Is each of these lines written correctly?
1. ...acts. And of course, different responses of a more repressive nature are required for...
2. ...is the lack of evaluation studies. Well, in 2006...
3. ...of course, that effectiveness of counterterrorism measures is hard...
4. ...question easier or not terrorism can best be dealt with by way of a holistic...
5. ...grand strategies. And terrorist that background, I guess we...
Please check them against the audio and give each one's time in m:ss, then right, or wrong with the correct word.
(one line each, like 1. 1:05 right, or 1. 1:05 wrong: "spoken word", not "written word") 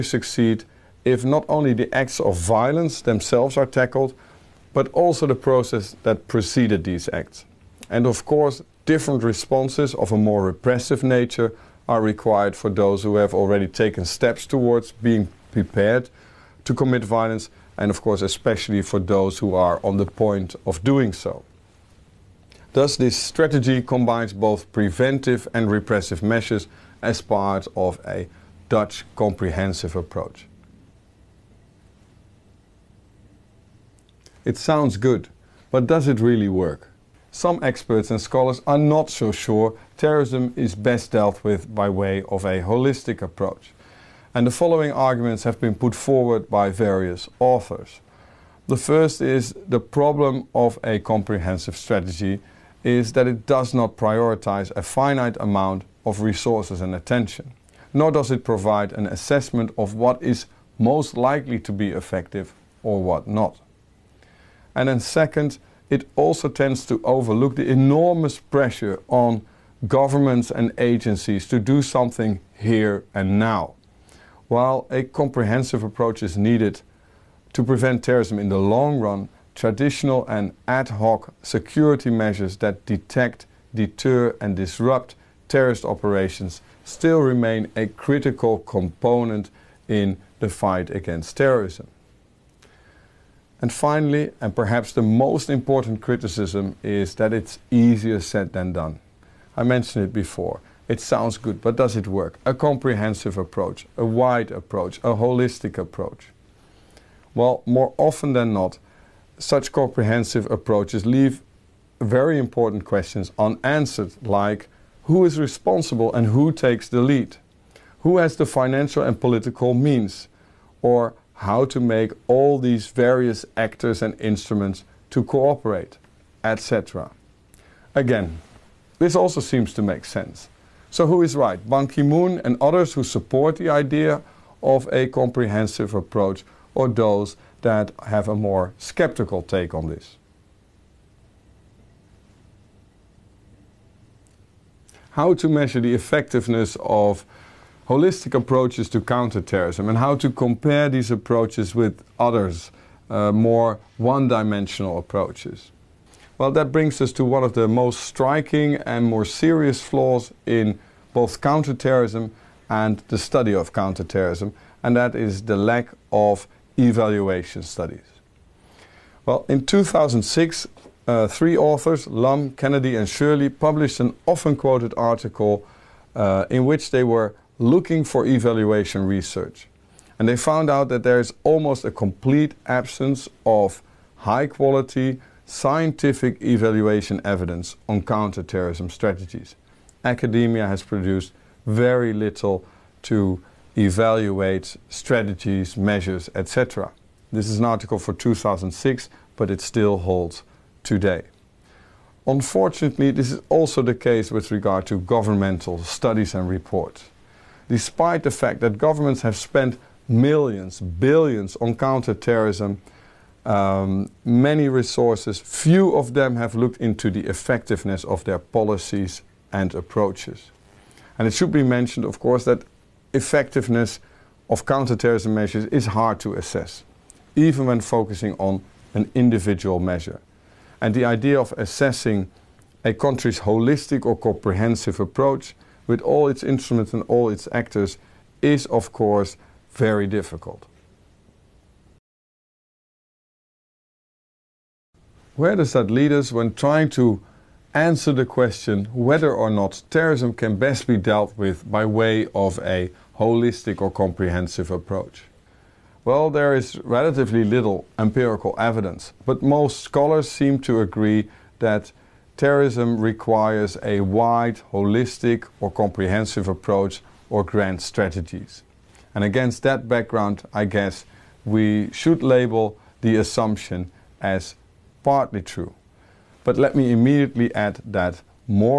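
1. 0:07 right
2. 2:45 right
3. 3:42 right
4. 4:08 wrong: "whether", not "easier"
5. 4:27 wrong: "against", not "terrorist".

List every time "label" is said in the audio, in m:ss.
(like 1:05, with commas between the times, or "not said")
4:32.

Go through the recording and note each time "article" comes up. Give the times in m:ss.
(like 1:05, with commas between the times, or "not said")
2:54, 3:17.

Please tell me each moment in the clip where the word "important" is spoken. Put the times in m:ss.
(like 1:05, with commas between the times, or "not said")
1:35, 1:52.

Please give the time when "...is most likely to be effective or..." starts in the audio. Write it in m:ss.
1:00.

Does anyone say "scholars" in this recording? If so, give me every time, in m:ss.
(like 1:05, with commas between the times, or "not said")
0:38, 4:19.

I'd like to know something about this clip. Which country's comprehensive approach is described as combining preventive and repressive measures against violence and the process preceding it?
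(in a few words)
Dutch.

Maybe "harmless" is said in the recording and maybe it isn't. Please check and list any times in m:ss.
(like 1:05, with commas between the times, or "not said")
not said.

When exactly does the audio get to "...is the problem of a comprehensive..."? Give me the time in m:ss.
0:49.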